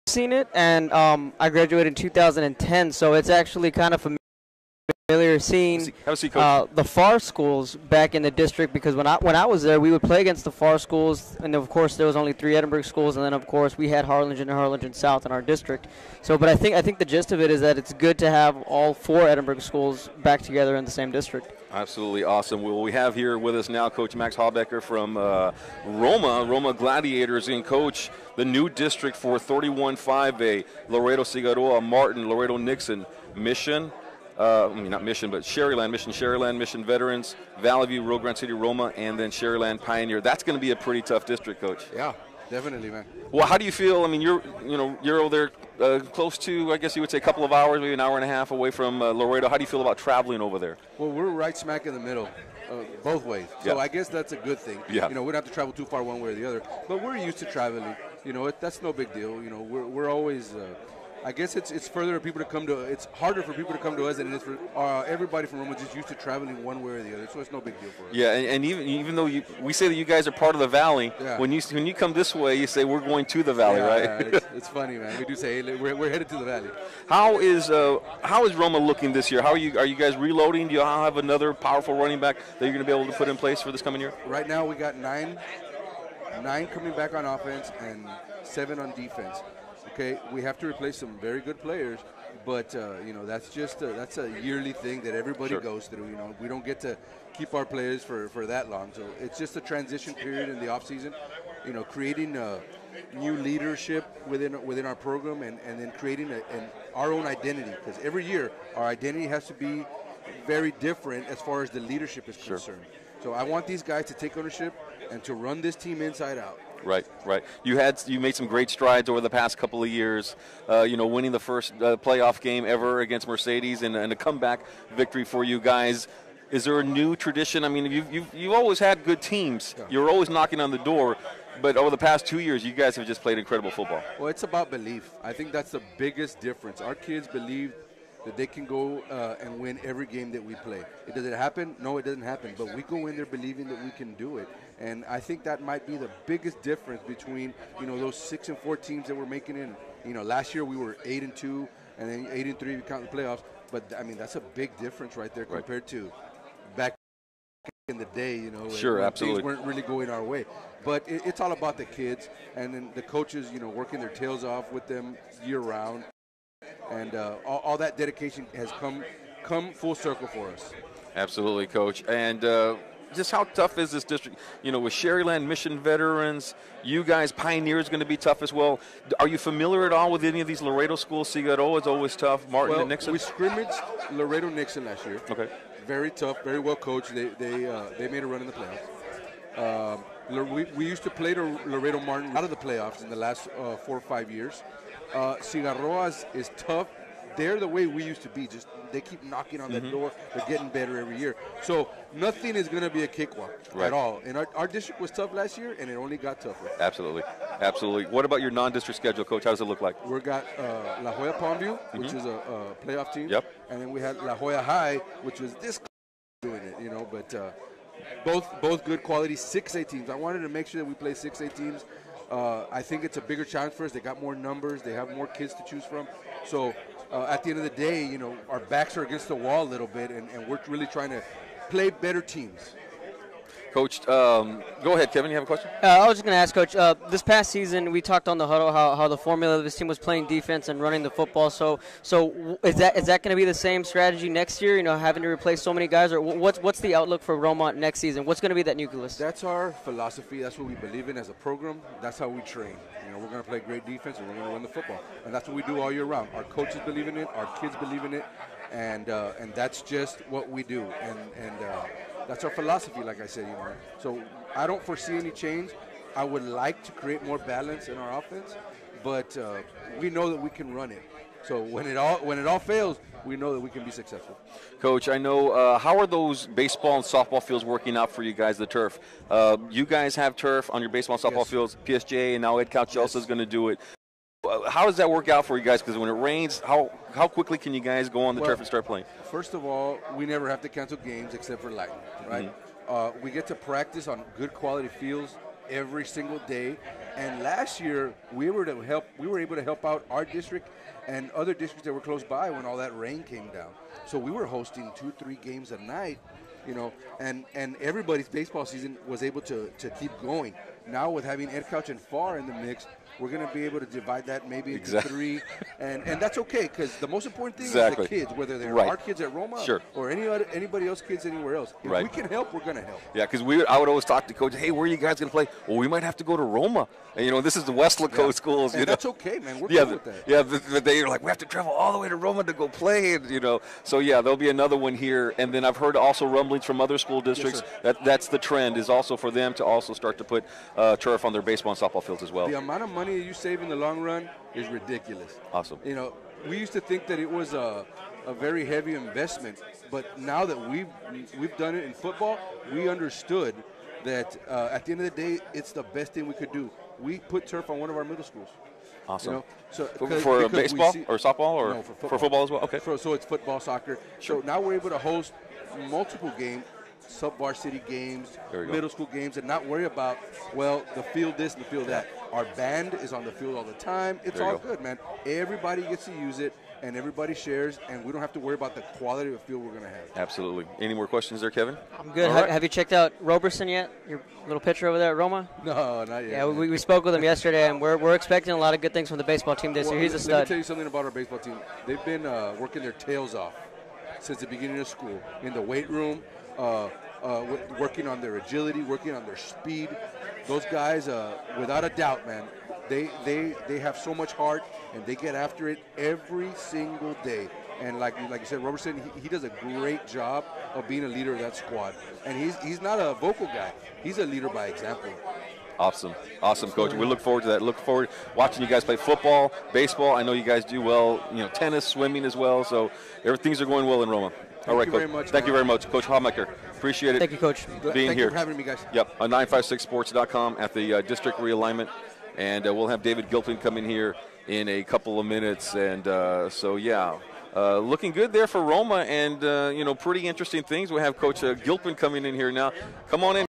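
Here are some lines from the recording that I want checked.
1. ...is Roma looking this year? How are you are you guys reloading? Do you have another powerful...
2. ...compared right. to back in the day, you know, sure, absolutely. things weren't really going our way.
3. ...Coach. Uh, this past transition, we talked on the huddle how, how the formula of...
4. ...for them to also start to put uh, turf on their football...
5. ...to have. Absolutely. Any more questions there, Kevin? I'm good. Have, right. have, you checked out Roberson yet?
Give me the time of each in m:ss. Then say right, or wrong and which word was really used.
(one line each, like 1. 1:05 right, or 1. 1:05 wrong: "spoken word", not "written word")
1. 1:18 right
2. 2:35 right
3. 3:56 wrong: "season", not "transition"
4. 5:39 wrong: "baseball", not "football"
5. 6:19 right.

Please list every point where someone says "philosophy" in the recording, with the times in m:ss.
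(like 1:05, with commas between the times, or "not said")
4:09, 4:22.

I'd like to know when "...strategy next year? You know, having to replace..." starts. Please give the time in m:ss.
4:03.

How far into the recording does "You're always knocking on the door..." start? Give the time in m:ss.
2:09.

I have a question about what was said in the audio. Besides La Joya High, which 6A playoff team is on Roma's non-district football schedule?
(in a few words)
La Joya Palmview.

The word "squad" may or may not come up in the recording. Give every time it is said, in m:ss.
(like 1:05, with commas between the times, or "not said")
6:51.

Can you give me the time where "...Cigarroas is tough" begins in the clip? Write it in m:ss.
3:15.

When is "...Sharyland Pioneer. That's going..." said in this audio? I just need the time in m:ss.
0:39.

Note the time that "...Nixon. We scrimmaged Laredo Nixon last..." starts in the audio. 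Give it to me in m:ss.
3:02.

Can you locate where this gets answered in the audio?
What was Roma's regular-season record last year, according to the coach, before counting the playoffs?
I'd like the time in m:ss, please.
2:31.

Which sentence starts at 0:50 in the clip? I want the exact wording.
Well, we're right smack in the middle, uh, both ways.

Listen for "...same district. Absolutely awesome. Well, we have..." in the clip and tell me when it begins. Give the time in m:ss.
0:20.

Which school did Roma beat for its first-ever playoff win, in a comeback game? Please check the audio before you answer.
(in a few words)
Mercedes.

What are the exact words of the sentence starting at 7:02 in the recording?
So everything's are going well in Roma.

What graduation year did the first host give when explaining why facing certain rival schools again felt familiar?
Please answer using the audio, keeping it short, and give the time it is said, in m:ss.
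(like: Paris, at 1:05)
2010, at 0:01.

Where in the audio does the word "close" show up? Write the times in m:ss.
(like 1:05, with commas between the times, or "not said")
0:46, 5:02.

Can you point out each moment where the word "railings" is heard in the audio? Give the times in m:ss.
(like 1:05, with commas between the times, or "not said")
not said.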